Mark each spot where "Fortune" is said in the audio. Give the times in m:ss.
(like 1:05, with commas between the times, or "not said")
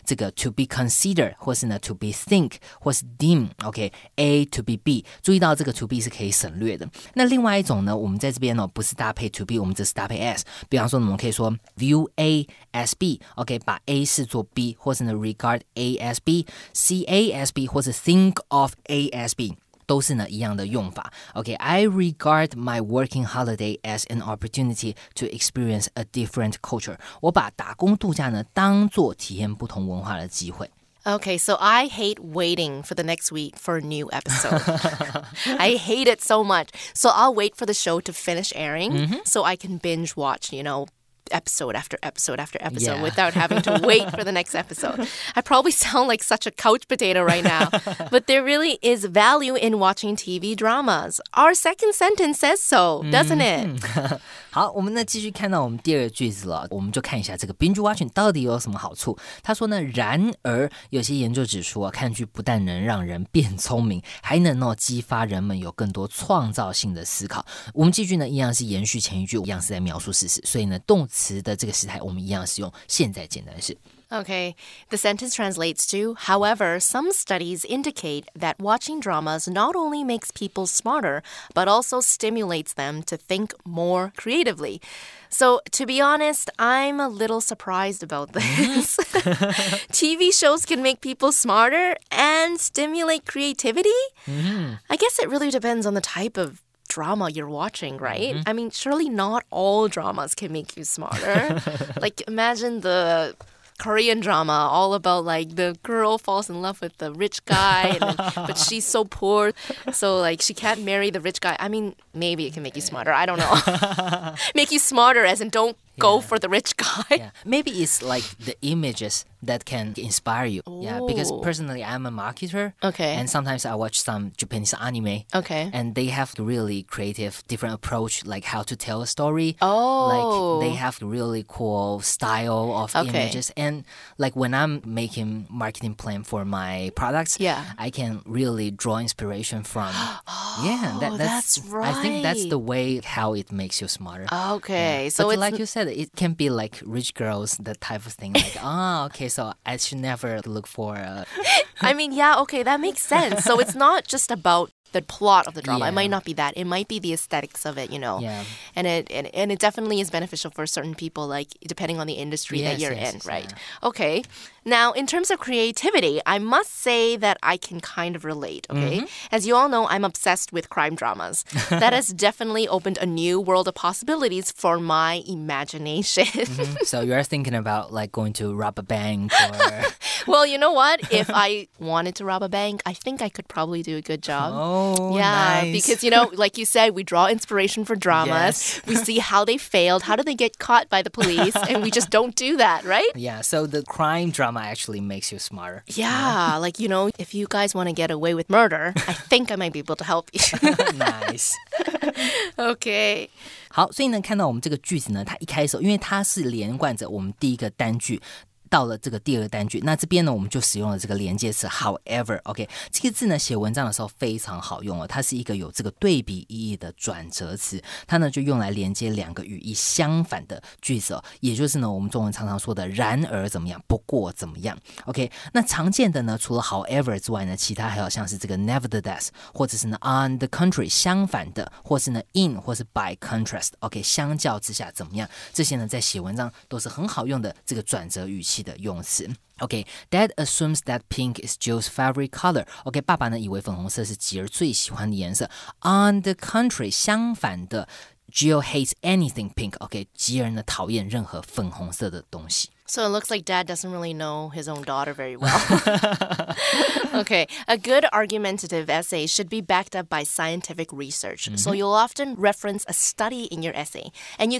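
not said.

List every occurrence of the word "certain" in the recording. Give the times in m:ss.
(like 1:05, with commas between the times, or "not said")
2:40.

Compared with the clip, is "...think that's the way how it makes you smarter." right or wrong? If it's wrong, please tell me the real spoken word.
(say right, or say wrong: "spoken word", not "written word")
right.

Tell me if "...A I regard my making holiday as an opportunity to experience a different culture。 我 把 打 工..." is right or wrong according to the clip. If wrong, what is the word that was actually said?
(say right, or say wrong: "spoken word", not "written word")
wrong: "working", not "making".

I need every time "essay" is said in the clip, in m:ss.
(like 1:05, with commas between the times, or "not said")
4:18, 4:23.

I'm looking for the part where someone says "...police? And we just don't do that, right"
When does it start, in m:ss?
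3:11.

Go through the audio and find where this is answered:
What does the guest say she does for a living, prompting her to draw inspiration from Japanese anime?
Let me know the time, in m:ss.
2:02.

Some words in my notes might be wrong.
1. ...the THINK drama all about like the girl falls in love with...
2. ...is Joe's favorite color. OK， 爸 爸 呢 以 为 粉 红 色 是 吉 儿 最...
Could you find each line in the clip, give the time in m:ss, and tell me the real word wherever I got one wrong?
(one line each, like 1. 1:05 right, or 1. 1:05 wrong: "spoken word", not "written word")
1. 1:42 wrong: "Korean", not "THINK"
2. 4:01 right.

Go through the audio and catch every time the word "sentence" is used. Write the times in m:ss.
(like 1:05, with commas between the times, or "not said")
0:51, 1:14.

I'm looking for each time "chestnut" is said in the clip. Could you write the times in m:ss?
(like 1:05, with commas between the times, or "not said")
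not said.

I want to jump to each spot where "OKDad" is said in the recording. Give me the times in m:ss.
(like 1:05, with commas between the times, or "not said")
3:59.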